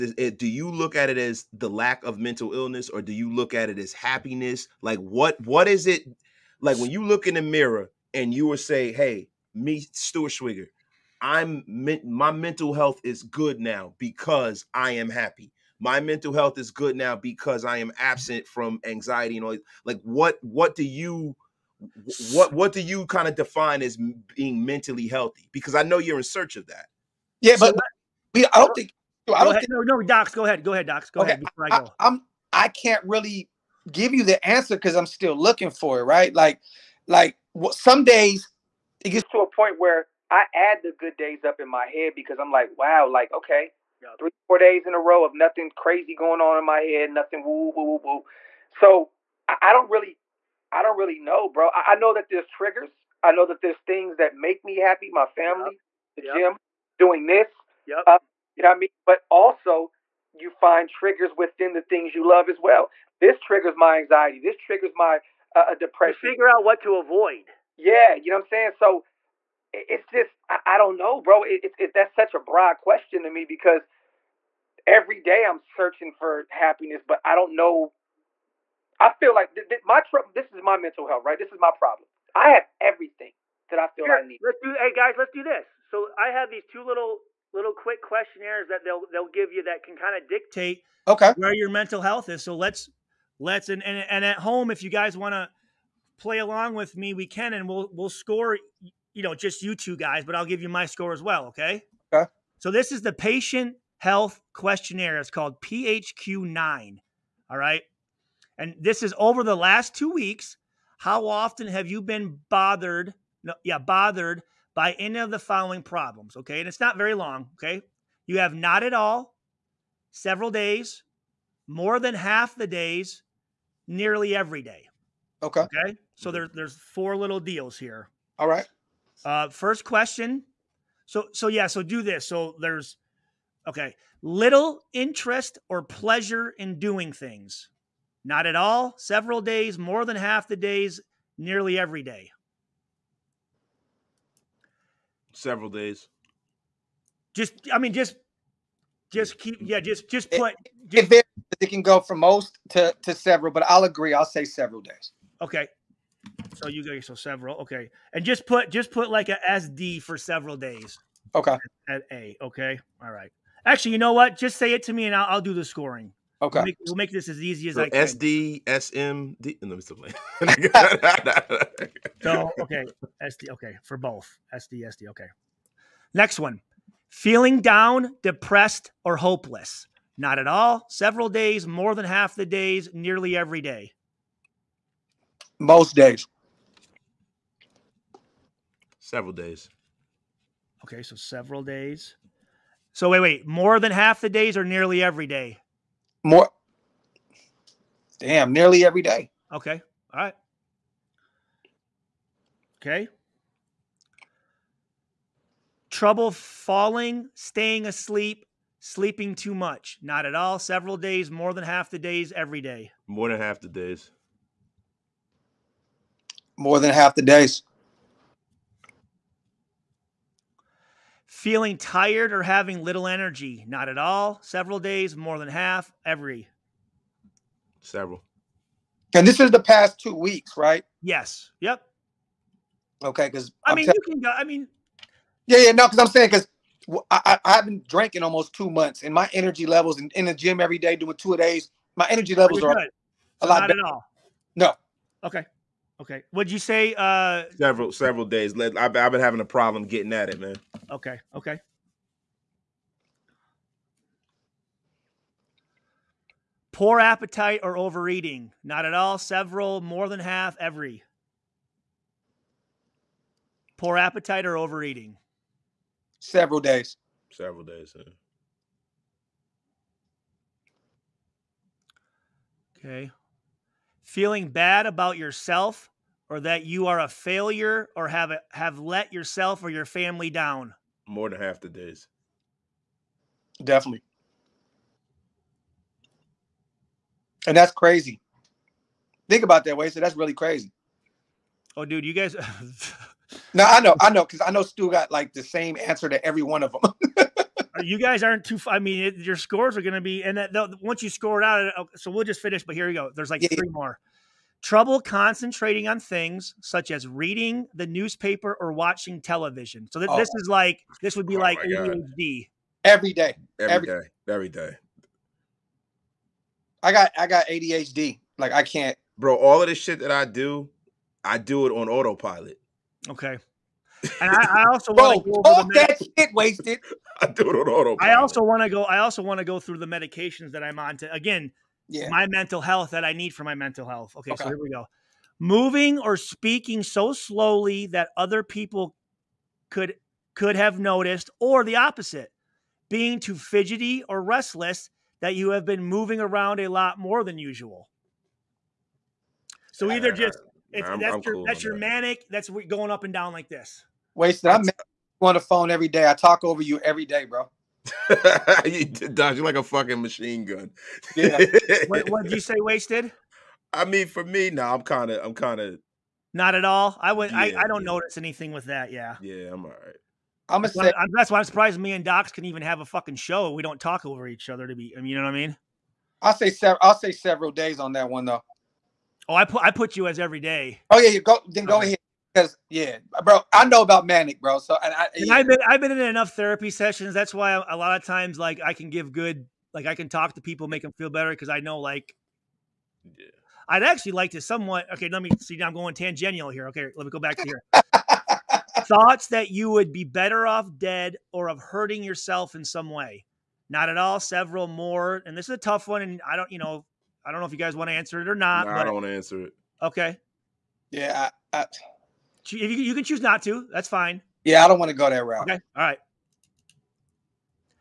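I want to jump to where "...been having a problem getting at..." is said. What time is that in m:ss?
4:09.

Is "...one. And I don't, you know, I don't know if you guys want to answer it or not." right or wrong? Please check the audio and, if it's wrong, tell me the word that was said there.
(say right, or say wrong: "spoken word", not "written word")
right.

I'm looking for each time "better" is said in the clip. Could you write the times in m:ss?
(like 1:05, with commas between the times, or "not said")
4:03, 6:31, 6:40.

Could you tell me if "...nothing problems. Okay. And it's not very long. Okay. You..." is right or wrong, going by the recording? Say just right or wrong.
wrong.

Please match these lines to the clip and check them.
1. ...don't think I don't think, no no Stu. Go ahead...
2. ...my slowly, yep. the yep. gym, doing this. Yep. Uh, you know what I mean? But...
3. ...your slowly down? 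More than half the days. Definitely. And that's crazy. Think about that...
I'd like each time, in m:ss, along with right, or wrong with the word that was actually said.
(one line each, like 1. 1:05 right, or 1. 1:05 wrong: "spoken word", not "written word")
1. 0:28 wrong: "Docs", not "Stu"
2. 0:55 wrong: "family", not "slowly"
3. 4:39 wrong: "family", not "slowly".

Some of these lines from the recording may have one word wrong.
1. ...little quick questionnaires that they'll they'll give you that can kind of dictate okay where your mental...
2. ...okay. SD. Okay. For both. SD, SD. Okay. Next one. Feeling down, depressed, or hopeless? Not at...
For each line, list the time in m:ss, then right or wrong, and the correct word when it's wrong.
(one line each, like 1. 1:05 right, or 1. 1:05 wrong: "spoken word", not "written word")
1. 1:27 right
2. 2:52 right.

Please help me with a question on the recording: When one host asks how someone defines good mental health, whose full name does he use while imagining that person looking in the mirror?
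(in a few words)
Stuart Schweigert.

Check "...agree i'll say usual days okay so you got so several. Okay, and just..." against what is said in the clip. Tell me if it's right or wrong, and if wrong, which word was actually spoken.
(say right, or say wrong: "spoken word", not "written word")
wrong: "several", not "usual".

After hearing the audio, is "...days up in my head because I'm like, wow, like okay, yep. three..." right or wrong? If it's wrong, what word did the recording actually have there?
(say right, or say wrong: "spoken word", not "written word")
right.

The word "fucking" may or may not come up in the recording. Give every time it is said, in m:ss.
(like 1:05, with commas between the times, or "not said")
5:59, 6:12.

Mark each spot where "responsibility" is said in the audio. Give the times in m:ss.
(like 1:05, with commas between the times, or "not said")
not said.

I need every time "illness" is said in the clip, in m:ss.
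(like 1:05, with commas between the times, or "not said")
0:02.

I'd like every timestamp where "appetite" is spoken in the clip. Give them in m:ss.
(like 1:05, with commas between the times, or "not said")
4:16, 4:23.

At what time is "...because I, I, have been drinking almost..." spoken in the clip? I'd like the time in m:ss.
3:56.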